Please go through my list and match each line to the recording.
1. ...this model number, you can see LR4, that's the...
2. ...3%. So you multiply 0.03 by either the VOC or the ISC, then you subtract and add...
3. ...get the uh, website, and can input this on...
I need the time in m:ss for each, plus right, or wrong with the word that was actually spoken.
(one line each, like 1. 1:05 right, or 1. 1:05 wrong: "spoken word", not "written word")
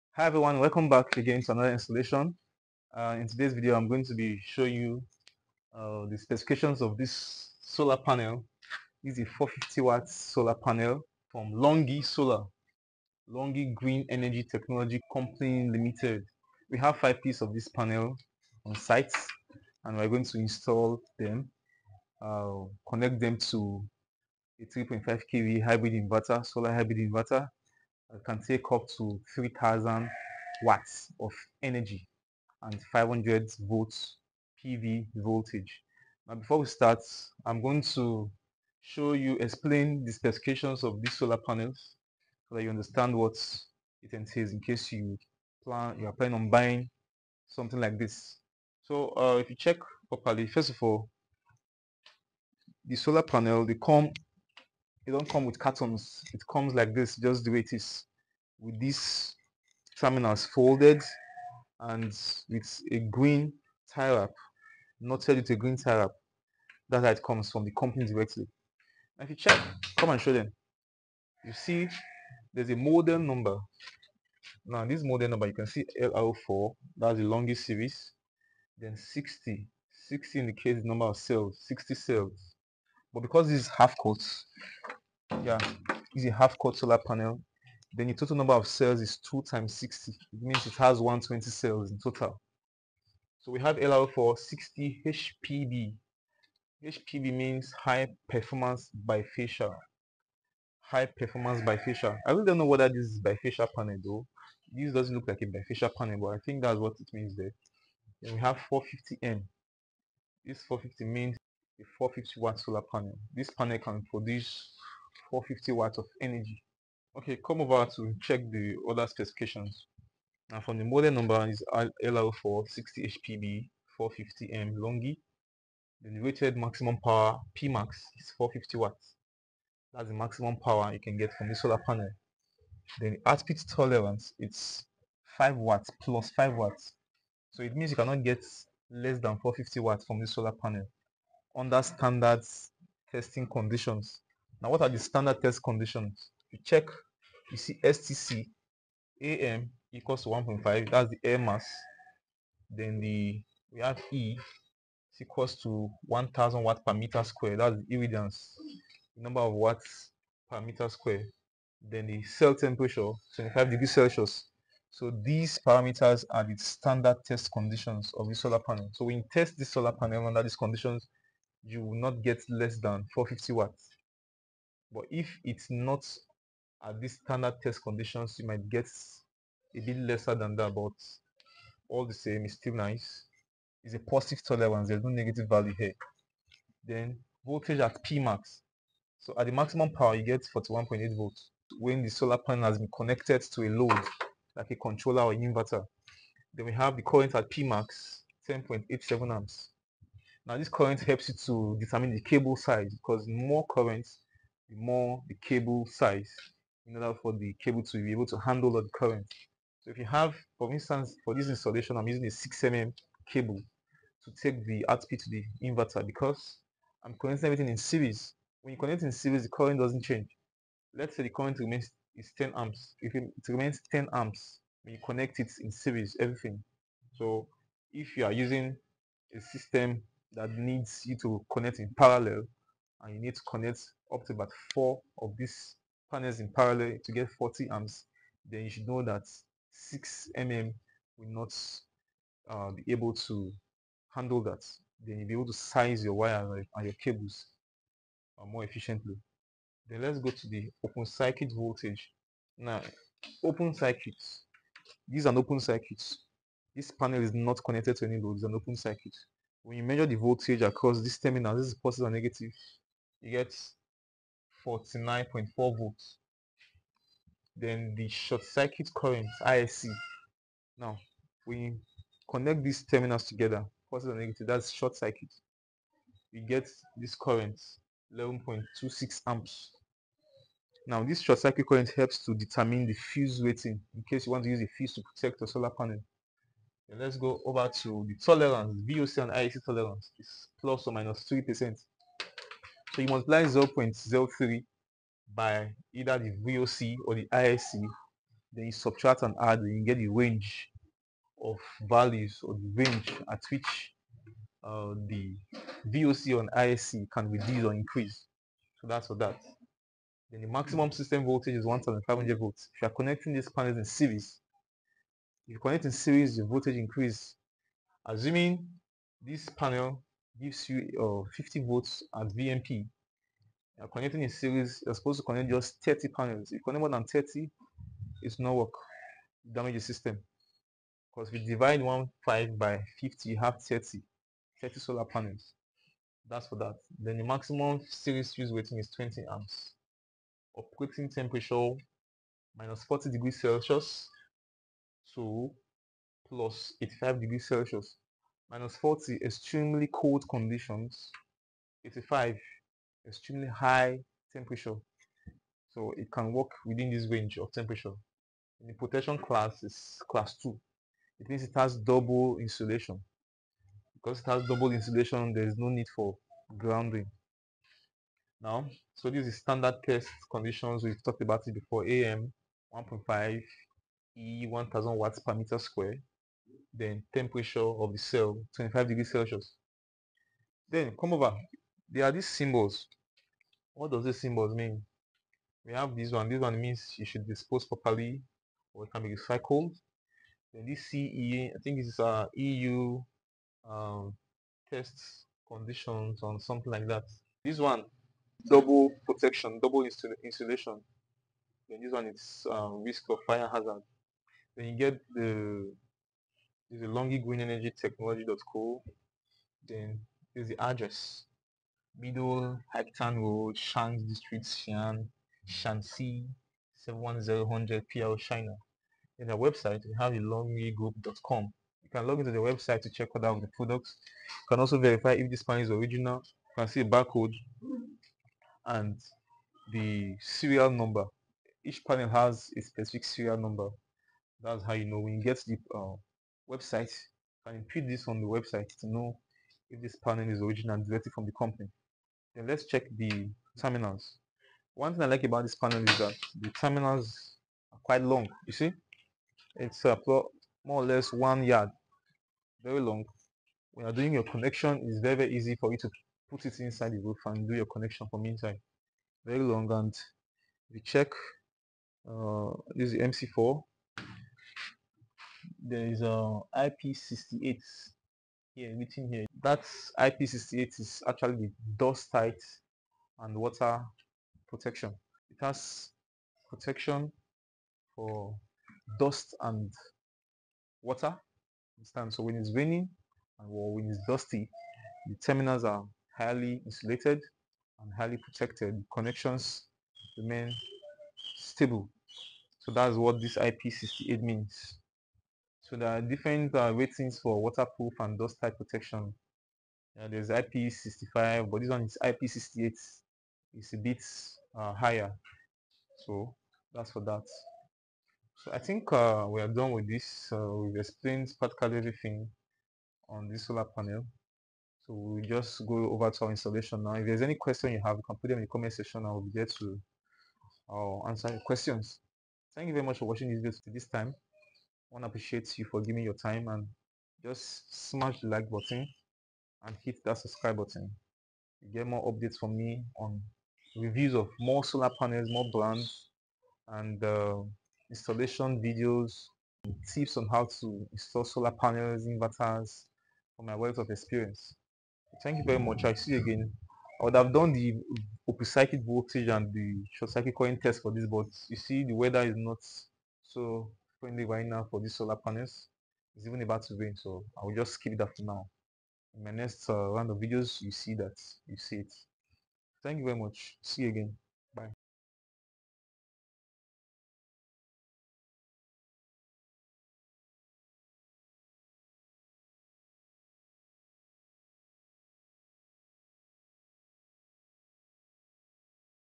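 1. 1:14 right
2. 4:51 right
3. 7:15 right.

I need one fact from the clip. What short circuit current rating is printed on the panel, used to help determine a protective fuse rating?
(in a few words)
11.26 amps.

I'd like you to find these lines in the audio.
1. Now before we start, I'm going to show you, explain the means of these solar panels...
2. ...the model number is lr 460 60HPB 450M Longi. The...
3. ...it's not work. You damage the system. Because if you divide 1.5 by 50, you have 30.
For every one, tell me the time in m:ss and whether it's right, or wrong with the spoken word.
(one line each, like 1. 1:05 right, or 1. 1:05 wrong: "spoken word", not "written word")
1. 0:36 wrong: "specifications", not "means"
2. 2:00 right
3. 5:28 right.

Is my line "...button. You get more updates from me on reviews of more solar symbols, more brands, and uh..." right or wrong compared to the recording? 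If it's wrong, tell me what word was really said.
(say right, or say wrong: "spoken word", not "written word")
wrong: "panels", not "symbols".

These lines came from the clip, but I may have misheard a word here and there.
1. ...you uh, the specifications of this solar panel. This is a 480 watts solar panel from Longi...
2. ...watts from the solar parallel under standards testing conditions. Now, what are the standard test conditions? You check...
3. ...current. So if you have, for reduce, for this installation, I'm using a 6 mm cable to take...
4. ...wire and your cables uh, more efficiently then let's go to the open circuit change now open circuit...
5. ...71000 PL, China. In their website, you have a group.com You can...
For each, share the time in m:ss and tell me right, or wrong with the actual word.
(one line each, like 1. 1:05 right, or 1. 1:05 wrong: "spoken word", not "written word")
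1. 0:04 wrong: "450", not "480"
2. 2:19 wrong: "panel", not "parallel"
3. 3:28 wrong: "instance", not "reduce"
4. 4:06 wrong: "voltage", not "change"
5. 6:56 right.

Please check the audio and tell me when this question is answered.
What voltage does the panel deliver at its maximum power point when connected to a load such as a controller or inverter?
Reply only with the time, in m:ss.
3:10.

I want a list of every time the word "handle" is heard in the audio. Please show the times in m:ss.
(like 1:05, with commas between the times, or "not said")
3:28, 4:04.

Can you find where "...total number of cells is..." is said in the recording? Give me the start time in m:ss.
1:28.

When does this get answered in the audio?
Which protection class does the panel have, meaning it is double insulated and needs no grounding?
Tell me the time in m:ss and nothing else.
6:00.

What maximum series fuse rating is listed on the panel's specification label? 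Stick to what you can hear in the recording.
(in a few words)
20 amps.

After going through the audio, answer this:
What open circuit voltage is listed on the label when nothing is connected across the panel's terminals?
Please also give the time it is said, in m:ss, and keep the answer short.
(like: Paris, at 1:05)
49.4 volts, at 4:24.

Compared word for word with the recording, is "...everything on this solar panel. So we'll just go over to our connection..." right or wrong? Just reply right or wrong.
wrong.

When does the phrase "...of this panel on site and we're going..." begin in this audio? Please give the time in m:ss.
0:17.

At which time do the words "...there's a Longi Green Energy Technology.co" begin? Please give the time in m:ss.
6:46.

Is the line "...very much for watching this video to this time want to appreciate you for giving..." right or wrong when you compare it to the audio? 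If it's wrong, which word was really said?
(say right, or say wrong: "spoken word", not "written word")
right.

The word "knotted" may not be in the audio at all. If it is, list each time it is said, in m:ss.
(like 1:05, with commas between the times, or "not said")
1:04.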